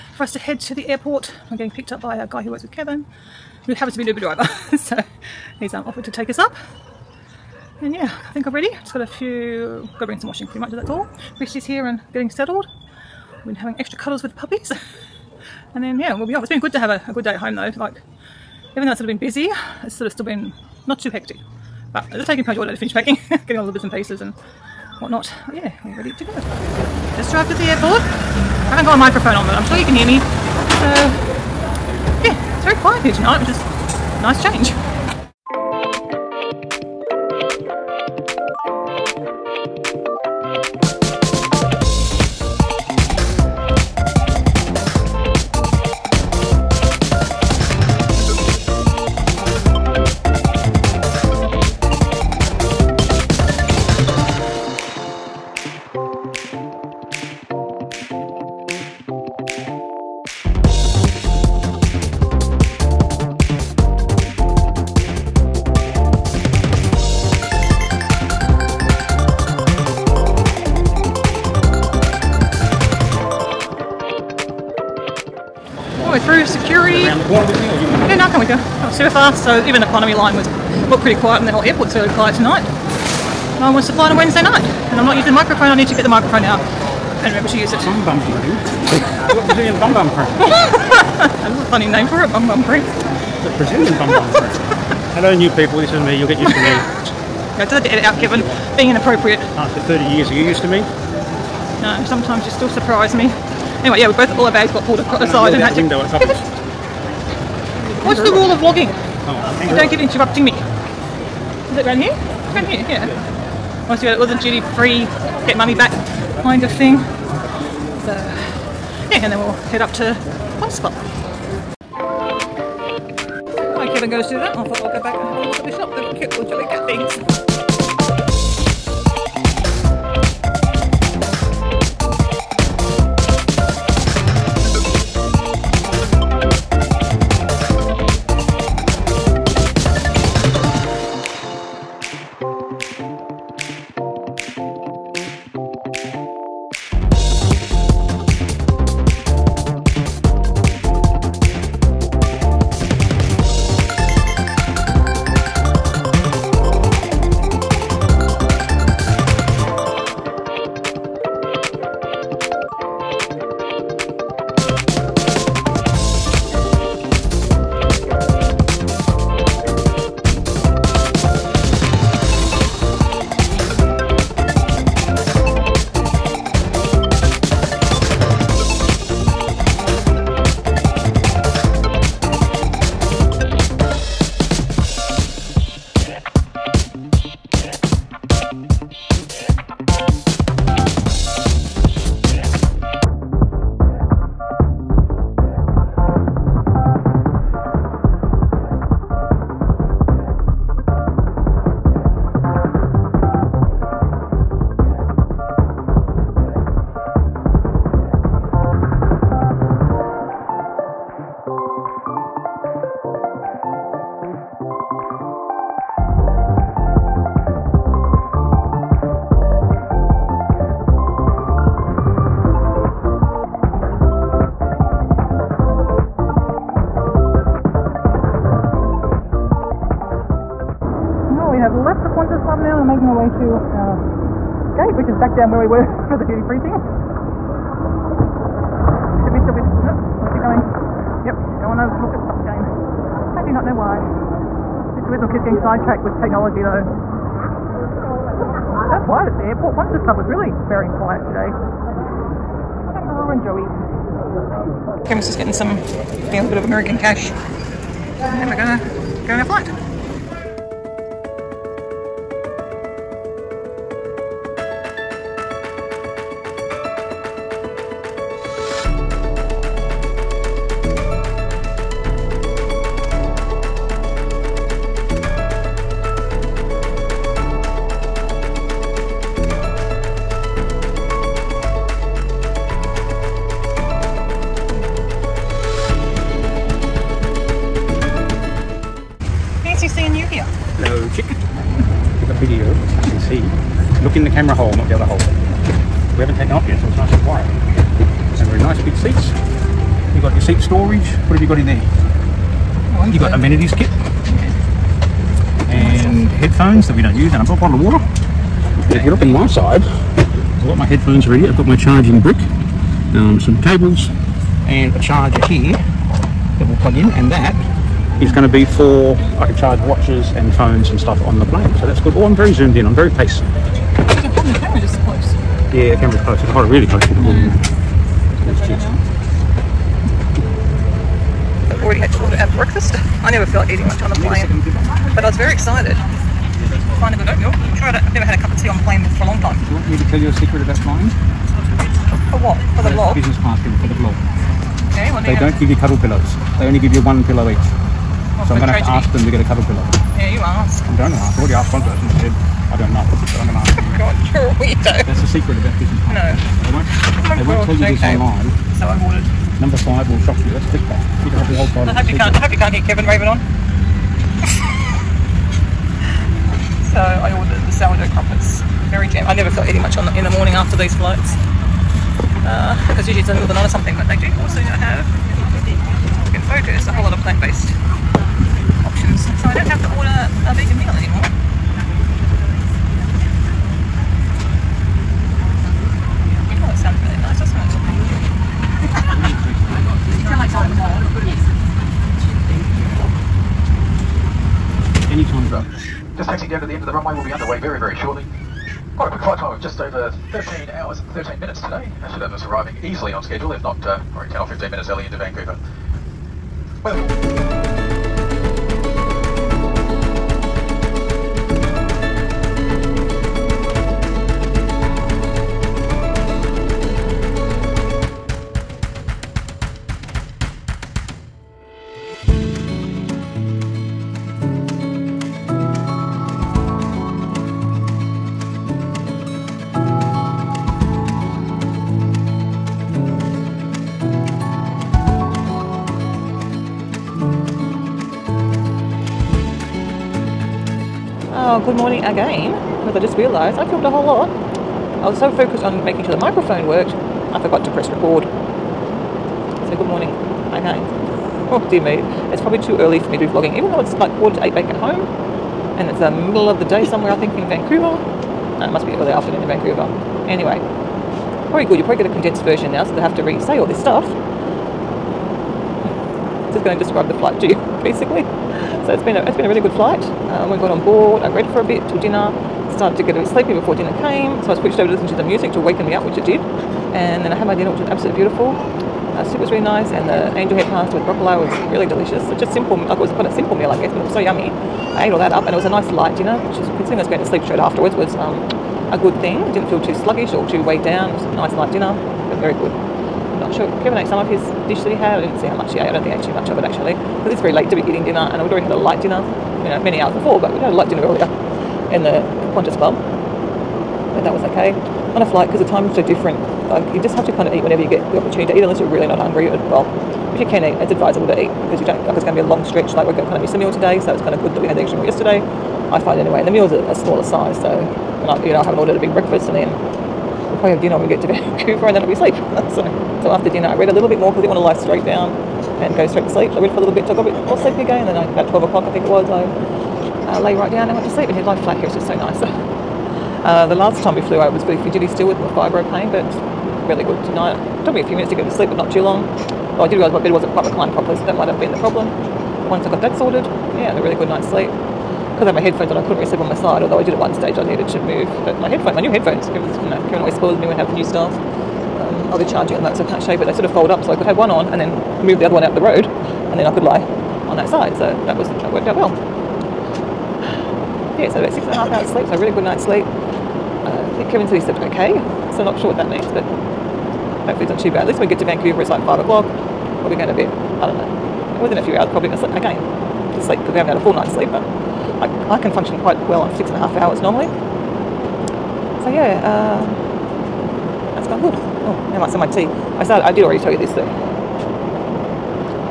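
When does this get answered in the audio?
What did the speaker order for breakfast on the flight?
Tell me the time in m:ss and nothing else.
6:07.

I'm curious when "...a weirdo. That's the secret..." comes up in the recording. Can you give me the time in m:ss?
5:54.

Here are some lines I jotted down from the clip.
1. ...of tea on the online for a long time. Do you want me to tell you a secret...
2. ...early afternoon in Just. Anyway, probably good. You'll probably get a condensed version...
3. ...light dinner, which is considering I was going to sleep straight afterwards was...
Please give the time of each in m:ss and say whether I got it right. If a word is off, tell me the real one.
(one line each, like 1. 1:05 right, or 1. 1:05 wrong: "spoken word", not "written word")
1. 5:38 wrong: "plane", not "online"
2. 7:38 wrong: "Vancouver", not "Just"
3. 8:05 right.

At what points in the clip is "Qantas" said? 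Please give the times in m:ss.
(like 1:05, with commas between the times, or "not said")
3:52, 8:22.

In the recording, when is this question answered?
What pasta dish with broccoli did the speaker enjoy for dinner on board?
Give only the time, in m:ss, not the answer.
8:00.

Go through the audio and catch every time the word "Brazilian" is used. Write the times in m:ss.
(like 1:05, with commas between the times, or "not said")
1:29, 1:33.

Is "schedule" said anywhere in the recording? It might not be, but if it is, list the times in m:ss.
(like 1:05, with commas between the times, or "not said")
6:43.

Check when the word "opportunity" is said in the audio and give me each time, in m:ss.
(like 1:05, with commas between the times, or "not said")
8:28.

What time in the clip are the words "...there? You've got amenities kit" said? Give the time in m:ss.
5:01.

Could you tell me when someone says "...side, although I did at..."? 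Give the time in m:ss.
9:06.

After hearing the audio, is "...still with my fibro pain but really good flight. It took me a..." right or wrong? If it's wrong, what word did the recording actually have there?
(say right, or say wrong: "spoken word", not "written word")
wrong: "tonight", not "flight".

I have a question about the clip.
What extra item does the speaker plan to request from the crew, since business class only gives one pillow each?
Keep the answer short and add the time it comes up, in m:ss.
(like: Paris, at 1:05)
cuddle pillow, at 5:49.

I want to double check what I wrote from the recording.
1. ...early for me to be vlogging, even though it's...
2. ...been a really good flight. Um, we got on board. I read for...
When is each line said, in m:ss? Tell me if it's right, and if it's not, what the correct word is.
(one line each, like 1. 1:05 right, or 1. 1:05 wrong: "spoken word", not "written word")
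1. 7:32 right
2. 7:49 right.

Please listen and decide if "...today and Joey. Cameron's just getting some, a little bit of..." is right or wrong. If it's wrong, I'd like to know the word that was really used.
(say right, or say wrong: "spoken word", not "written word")
right.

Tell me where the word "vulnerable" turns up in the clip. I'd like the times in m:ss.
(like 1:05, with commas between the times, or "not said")
not said.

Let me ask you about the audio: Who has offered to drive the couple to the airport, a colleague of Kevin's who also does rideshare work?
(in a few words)
Uber driver.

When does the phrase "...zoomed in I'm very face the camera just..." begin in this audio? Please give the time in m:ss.
5:22.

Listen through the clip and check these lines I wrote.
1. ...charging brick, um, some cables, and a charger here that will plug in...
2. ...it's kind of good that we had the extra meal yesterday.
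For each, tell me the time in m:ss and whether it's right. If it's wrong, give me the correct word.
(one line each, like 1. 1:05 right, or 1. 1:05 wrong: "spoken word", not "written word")
1. 5:11 right
2. 8:34 right.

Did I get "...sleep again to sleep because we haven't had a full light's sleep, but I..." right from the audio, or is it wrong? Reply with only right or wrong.
wrong.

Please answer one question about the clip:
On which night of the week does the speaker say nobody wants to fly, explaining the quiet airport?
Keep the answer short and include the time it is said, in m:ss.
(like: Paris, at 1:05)
Wednesday, at 1:24.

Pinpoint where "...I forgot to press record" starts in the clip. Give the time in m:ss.
7:27.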